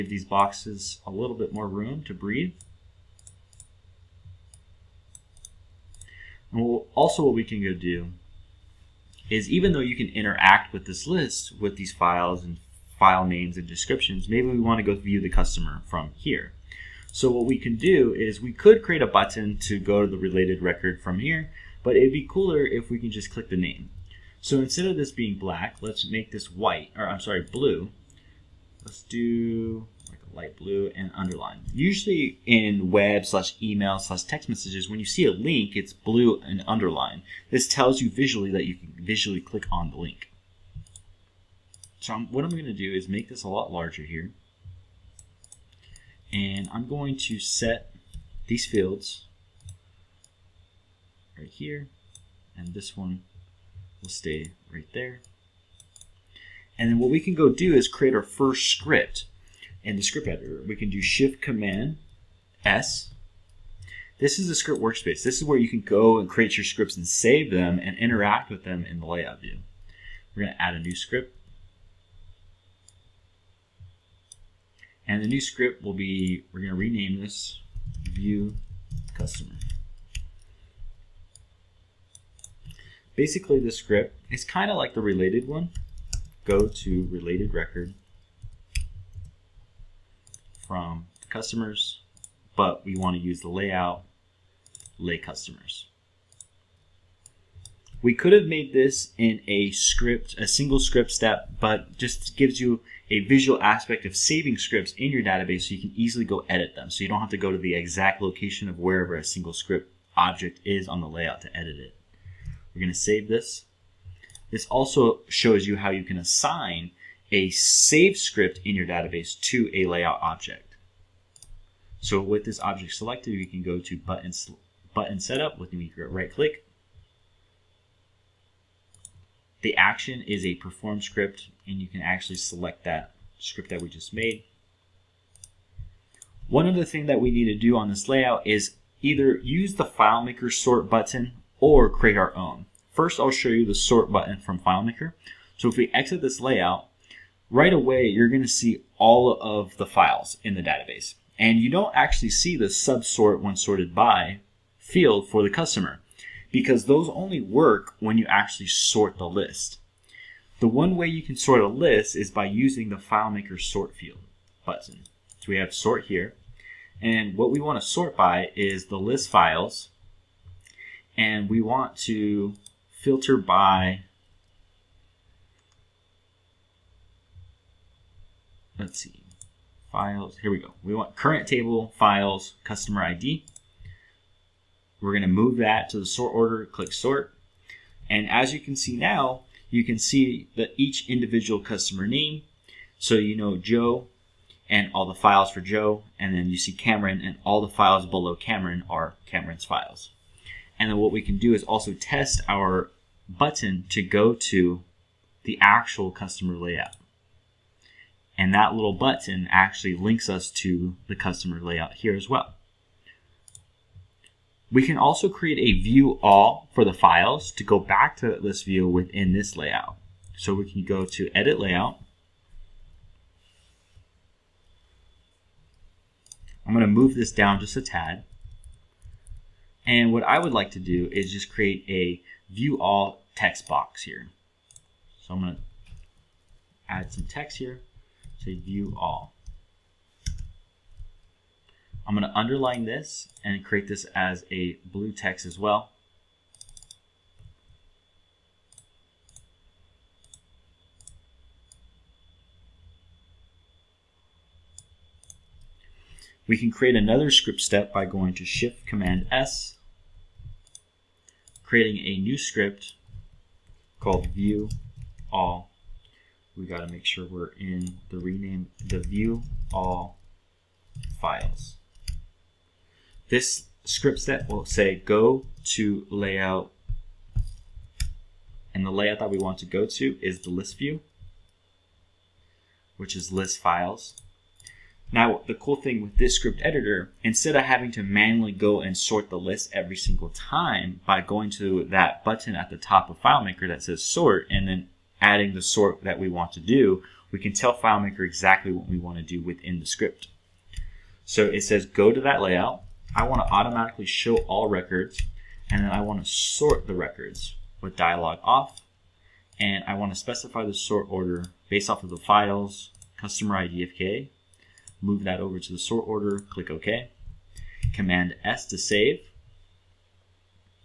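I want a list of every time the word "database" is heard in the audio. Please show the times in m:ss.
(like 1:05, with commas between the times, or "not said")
1:45, 1:58, 2:30.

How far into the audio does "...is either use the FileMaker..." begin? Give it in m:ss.
2:18.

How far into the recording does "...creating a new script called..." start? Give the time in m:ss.
4:21.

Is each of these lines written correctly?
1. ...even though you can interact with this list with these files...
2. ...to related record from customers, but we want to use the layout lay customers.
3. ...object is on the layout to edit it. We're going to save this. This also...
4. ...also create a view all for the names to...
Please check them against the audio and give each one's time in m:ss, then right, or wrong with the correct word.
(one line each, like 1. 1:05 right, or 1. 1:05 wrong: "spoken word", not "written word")
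1. 0:09 right
2. 1:26 right
3. 1:50 right
4. 3:34 wrong: "files", not "names".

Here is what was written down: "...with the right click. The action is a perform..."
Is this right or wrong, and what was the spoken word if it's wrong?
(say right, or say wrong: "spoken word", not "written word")
right.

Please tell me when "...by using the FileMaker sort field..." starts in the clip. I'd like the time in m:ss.
2:42.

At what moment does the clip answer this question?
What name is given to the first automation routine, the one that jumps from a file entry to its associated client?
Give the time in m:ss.
1:18.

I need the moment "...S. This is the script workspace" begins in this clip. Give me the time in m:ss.
1:02.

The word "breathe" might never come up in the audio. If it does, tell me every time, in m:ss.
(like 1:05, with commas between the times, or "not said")
0:02.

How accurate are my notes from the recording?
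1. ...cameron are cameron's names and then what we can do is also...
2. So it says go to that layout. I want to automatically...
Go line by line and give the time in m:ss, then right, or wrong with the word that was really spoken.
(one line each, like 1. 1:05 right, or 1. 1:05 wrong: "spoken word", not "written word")
1. 3:18 wrong: "files", not "names"
2. 5:01 right.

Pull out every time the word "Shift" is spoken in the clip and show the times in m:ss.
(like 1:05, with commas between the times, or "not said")
1:01, 4:18.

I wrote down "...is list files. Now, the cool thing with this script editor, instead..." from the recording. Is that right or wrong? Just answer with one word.
right.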